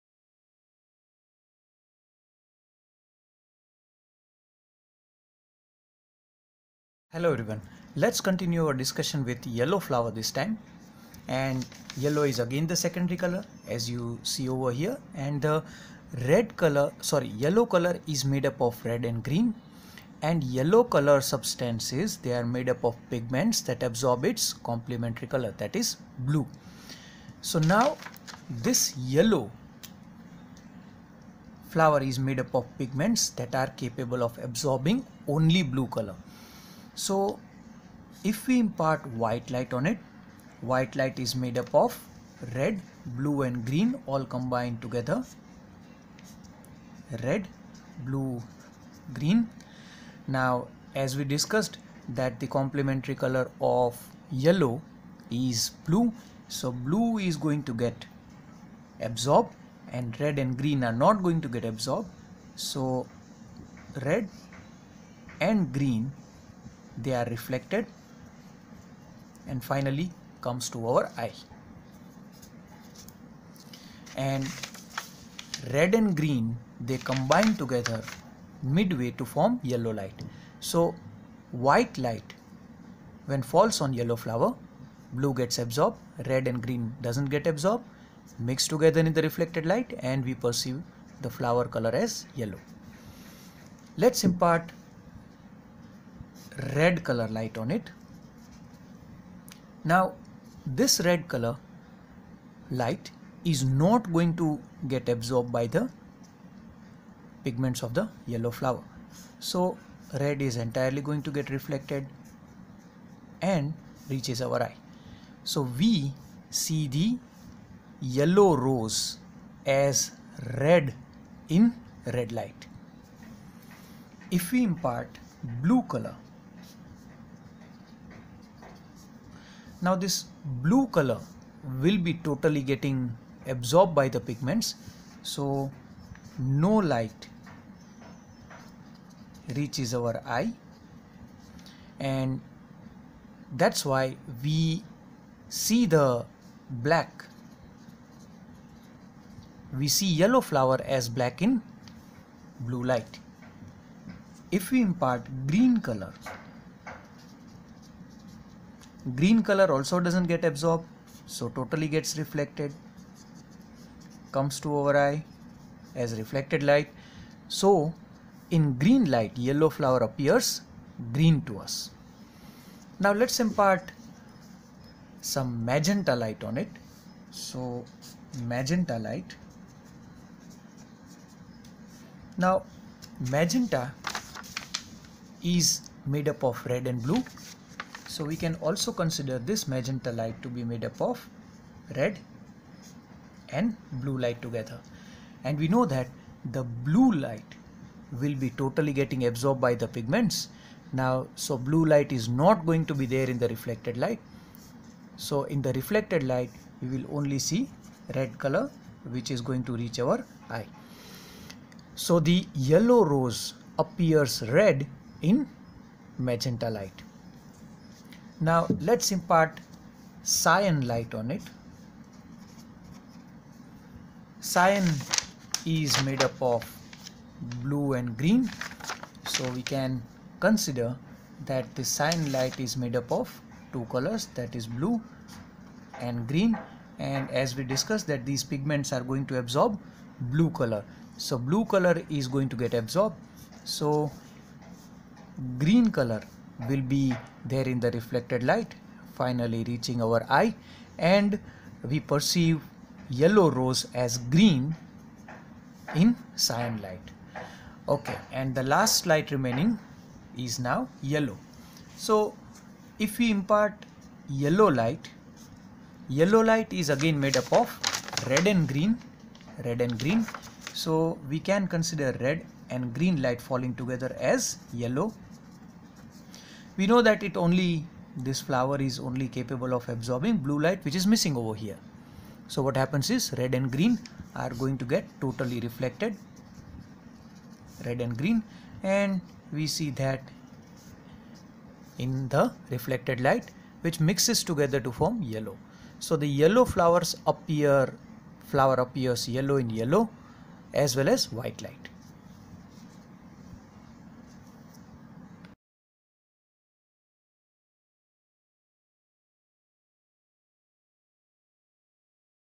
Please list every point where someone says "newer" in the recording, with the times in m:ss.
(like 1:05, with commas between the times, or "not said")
not said.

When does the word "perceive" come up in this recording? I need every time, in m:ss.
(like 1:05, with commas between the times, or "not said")
1:30, 4:11.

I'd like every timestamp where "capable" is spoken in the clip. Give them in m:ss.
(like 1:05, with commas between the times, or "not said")
0:33, 4:39.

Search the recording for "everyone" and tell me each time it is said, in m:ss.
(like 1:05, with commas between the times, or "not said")
0:07.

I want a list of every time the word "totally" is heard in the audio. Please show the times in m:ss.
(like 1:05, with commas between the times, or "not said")
2:12, 2:41, 3:18, 4:45.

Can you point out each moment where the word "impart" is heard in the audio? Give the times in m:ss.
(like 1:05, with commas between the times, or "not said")
0:38, 1:34, 2:04, 2:34, 2:53, 3:39, 4:23.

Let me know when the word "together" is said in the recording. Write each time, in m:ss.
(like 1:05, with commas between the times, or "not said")
0:44, 1:17, 1:28, 3:14, 4:33, 4:54.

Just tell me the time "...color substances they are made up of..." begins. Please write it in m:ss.
0:20.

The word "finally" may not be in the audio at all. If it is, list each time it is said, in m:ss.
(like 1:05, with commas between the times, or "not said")
1:09, 4:09.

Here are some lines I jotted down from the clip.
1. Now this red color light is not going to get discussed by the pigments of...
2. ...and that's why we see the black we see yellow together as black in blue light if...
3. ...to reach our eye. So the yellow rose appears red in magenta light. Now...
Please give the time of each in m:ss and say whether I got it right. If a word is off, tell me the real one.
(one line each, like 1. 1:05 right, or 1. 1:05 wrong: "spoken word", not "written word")
1. 1:39 wrong: "absorbed", not "discussed"
2. 2:21 wrong: "flower", not "together"
3. 3:29 right.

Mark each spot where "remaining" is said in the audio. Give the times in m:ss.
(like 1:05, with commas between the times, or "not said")
4:19.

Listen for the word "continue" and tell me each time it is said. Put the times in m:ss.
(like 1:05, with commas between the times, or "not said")
0:08.